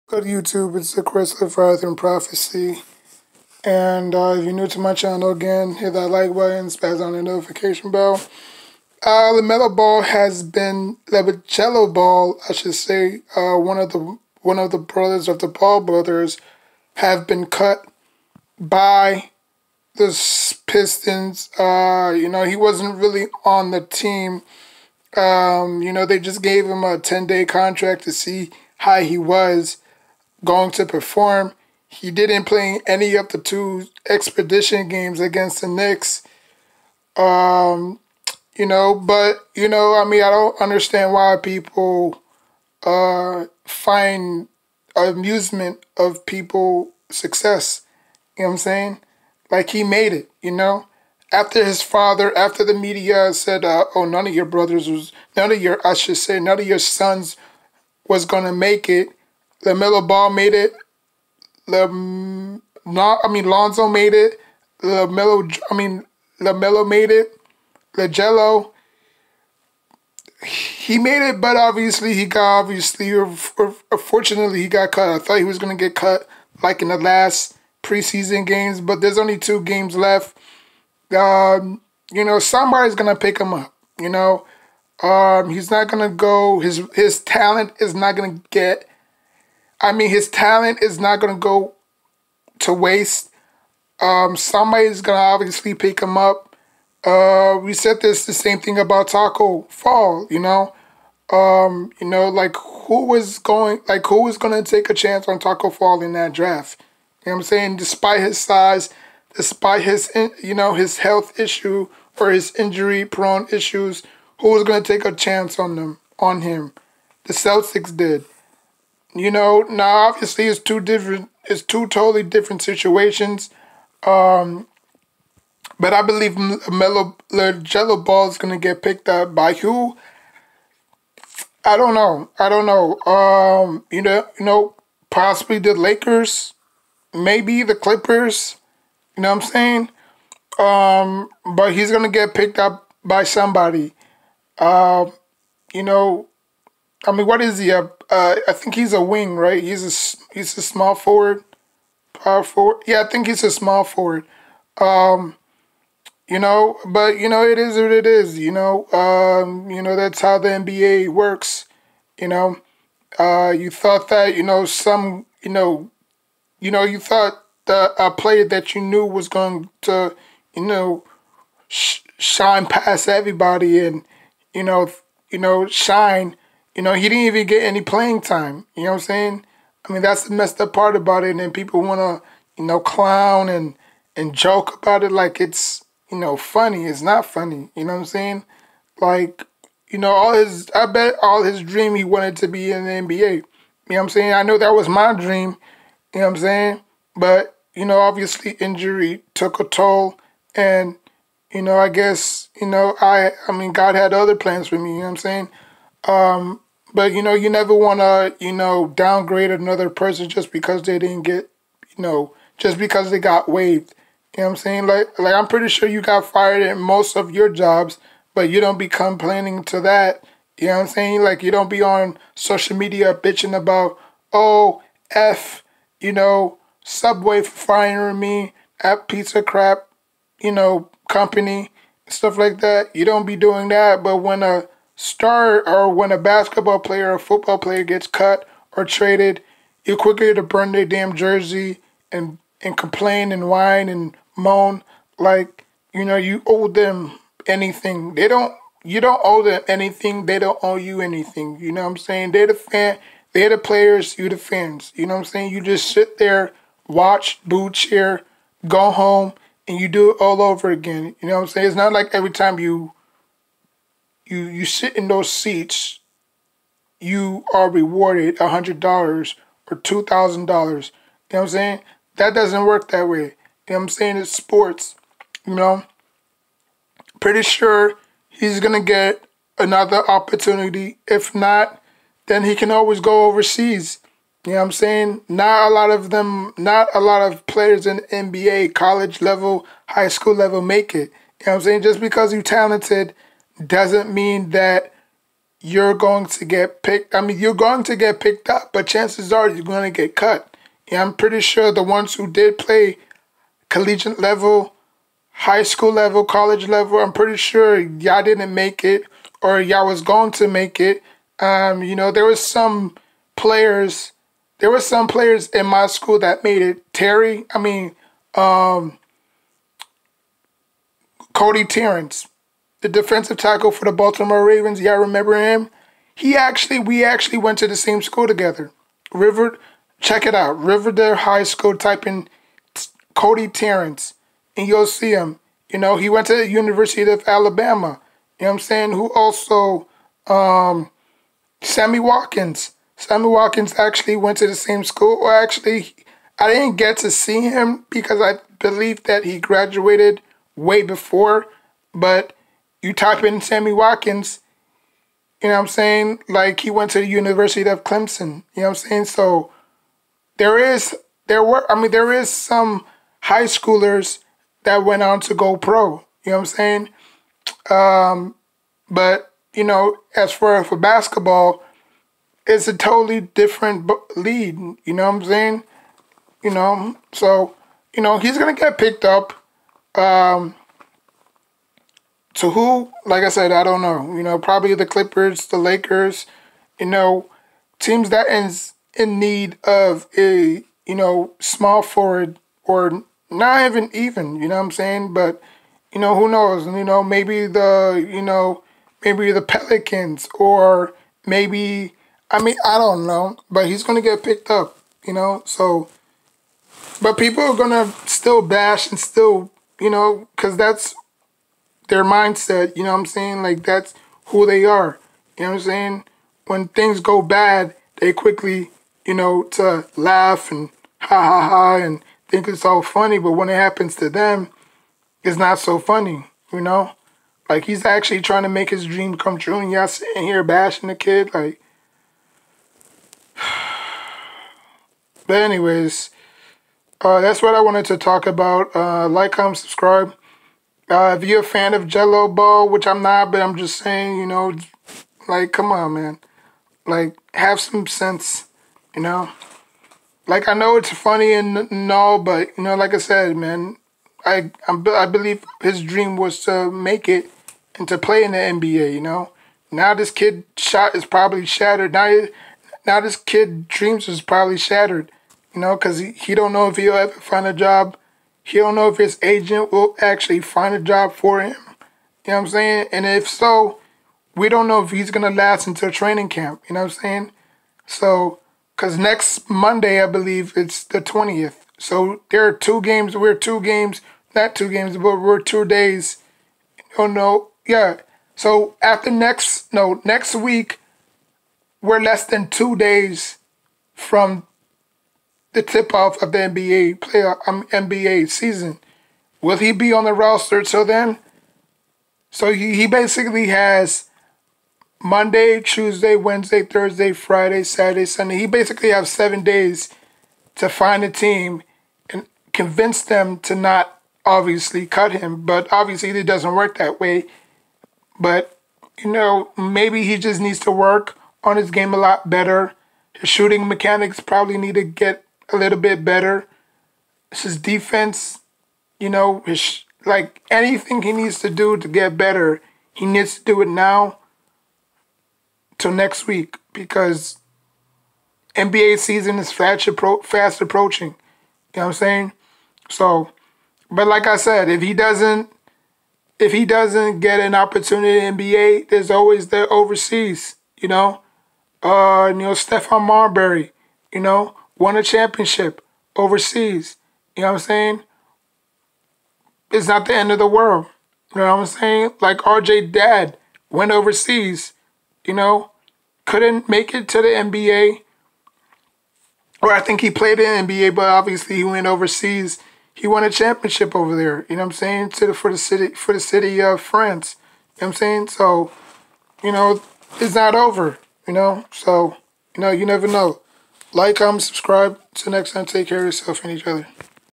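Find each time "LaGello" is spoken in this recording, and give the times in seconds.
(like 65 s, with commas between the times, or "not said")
67 s.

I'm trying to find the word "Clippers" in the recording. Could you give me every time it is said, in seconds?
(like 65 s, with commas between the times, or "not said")
137 s, 384 s.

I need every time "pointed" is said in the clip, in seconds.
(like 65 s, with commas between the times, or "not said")
not said.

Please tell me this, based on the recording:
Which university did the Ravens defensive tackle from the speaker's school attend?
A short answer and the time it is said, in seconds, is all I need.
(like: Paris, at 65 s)
University of Alabama, at 336 s.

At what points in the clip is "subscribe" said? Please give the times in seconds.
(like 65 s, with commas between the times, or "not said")
439 s, 584 s.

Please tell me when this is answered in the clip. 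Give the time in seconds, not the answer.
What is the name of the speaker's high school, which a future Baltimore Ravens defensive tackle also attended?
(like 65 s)
330 s.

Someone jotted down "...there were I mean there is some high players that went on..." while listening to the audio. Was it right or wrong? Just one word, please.
wrong.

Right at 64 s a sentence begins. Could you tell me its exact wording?
LaMelo, I mean, LaMelo made it.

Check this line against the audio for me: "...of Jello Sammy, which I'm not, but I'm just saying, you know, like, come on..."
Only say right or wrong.
wrong.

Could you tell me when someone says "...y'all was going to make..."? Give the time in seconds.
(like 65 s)
309 s.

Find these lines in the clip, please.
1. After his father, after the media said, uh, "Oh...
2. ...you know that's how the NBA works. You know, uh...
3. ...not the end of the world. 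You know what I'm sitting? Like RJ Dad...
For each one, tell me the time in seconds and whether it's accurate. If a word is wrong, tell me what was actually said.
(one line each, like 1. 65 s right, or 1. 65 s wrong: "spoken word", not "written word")
1. 51 s right
2. 159 s right
3. 559 s wrong: "saying", not "sitting".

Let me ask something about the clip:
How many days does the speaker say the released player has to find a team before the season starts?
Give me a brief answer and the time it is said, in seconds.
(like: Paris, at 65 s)
7, at 509 s.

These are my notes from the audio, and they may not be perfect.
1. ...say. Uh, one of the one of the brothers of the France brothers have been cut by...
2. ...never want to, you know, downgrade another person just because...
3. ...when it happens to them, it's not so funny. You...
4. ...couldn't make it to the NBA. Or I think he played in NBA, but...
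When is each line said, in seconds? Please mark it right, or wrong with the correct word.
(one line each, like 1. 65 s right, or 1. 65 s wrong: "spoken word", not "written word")
1. 12 s wrong: "Ball", not "France"
2. 207 s right
3. 423 s right
4. 566 s right.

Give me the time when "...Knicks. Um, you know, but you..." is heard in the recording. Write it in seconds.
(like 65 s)
35 s.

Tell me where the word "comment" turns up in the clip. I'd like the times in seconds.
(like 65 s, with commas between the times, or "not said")
439 s, 584 s.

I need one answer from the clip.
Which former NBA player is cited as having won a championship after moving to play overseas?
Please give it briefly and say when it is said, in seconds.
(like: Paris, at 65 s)
Stephon Marbury, at 552 s.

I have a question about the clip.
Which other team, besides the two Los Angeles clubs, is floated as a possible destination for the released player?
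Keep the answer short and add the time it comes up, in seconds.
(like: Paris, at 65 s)
Pelicans, at 399 s.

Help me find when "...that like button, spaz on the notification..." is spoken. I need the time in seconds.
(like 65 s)
5 s.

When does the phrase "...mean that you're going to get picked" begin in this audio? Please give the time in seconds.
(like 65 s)
294 s.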